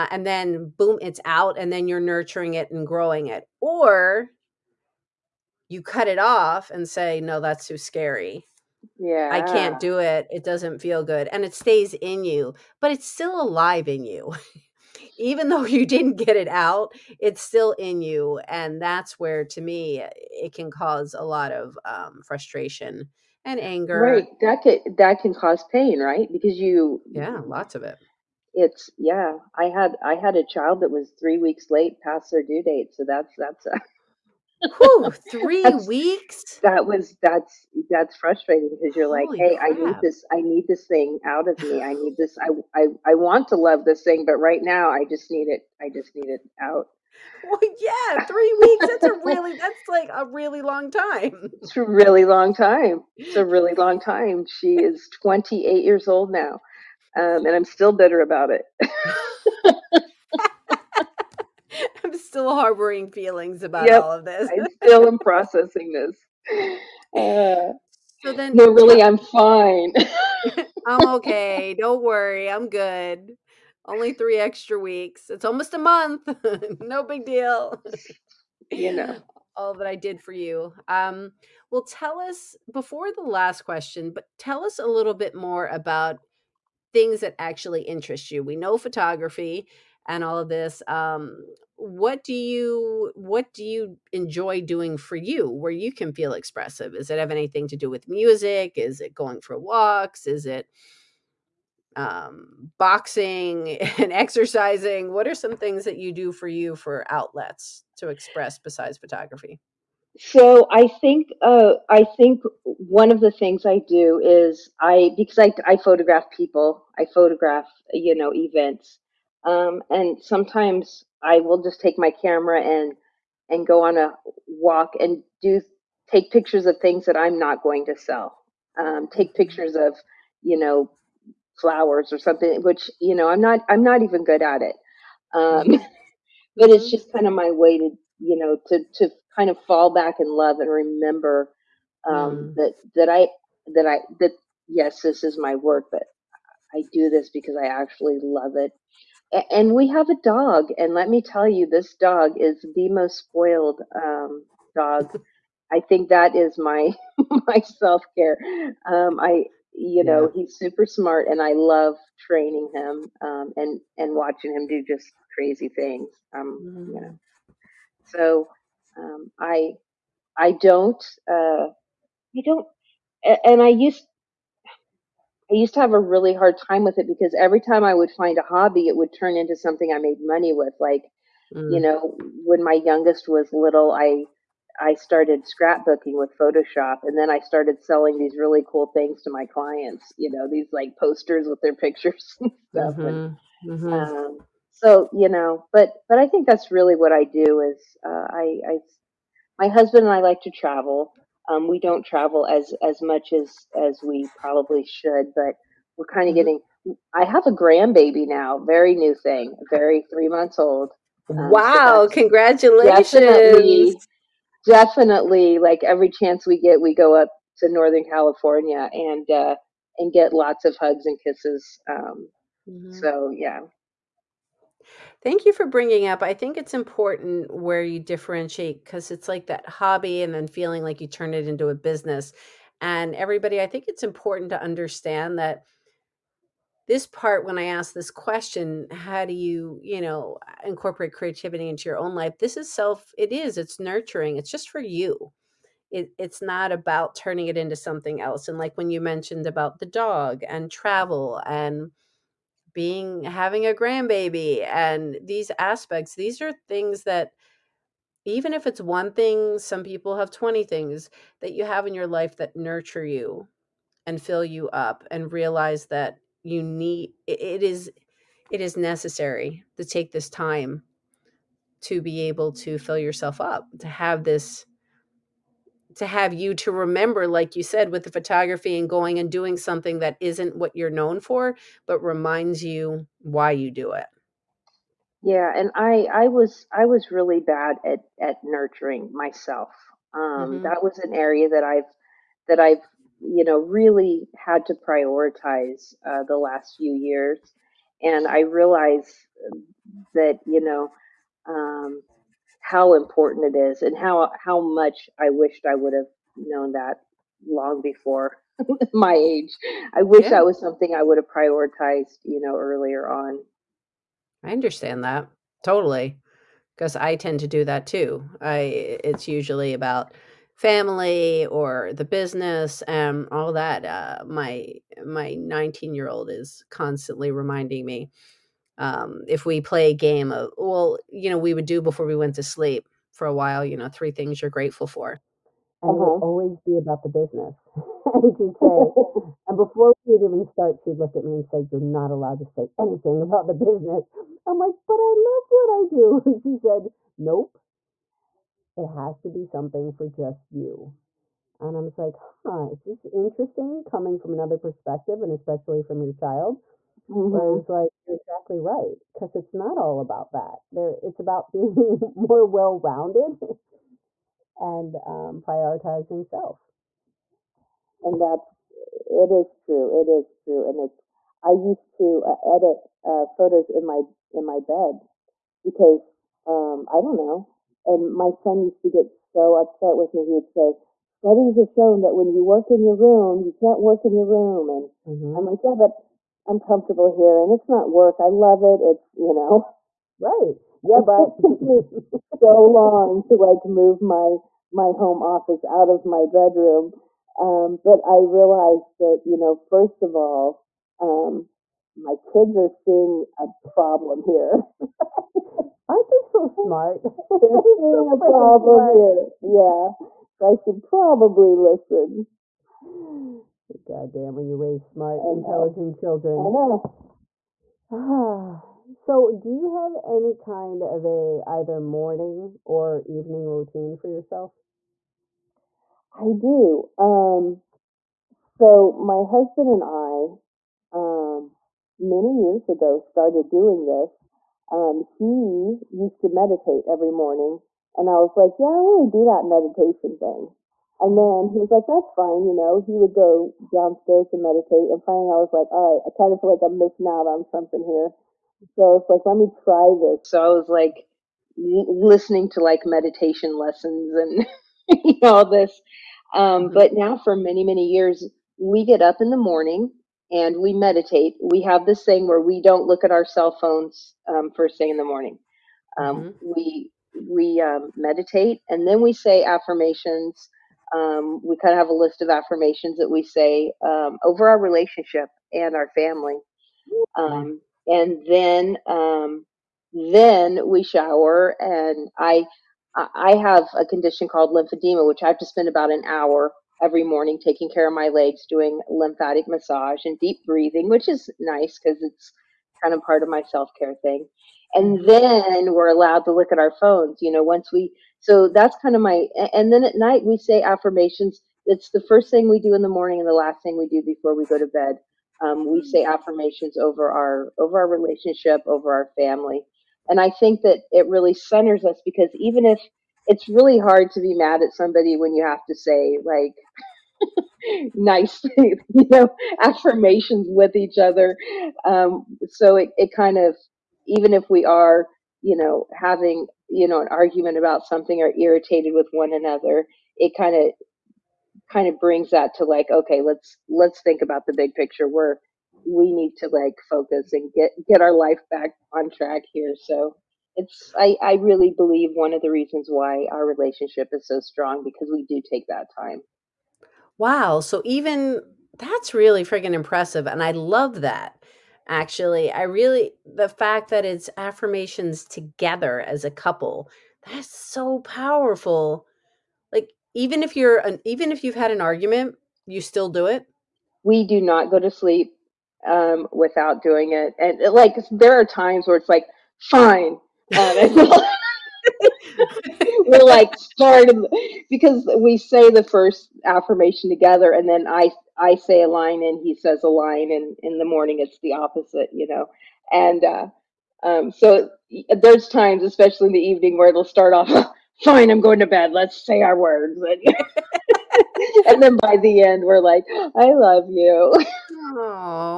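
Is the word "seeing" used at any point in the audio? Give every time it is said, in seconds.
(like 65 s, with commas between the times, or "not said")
402 s, 407 s.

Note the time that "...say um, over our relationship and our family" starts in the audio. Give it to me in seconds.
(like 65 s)
473 s.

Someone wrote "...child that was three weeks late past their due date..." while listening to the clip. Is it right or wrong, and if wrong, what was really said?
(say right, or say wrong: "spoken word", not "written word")
right.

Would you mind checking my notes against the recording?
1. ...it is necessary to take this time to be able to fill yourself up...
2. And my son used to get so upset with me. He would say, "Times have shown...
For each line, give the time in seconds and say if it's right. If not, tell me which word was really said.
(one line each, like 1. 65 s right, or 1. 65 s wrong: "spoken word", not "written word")
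1. 268 s right
2. 377 s wrong: "Studies", not "Times".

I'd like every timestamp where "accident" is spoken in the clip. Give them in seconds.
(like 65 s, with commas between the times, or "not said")
not said.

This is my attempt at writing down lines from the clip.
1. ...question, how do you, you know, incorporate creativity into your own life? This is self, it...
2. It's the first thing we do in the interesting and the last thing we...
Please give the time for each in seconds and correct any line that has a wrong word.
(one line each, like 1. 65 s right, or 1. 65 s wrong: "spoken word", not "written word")
1. 238 s right
2. 501 s wrong: "morning", not "interesting".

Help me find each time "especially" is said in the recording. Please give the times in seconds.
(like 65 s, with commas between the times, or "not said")
355 s, 585 s.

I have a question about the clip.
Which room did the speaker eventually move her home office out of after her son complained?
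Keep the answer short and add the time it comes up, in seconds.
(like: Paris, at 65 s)
Bedroom, at 396 s.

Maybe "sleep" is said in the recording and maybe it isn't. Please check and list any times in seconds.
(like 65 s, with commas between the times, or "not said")
332 s, 564 s.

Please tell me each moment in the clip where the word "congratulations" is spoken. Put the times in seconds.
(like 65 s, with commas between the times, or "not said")
212 s.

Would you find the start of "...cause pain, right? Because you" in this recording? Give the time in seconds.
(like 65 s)
25 s.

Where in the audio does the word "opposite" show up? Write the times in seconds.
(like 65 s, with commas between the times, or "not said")
581 s.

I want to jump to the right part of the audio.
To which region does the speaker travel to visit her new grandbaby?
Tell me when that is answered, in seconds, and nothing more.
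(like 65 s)
217 s.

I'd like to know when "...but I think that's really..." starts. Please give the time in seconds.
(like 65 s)
196 s.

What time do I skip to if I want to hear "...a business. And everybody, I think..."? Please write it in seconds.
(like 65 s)
231 s.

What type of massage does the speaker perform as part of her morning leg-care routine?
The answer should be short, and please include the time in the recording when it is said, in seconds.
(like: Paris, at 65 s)
Lymphatic massage, at 488 s.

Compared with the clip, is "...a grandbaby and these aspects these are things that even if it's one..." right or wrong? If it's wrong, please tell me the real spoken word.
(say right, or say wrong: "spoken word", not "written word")
right.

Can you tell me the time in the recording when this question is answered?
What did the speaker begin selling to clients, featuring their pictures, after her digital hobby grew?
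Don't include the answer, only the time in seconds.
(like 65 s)
190 s.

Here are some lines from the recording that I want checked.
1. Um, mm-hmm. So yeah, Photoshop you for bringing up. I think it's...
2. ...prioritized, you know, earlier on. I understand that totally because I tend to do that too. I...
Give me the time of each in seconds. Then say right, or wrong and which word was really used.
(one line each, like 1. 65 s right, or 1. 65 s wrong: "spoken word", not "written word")
1. 221 s wrong: "Thank", not "Photoshop"
2. 311 s right.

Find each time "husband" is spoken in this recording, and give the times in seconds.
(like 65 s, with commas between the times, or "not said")
199 s, 429 s.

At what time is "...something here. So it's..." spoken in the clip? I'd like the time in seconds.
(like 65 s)
447 s.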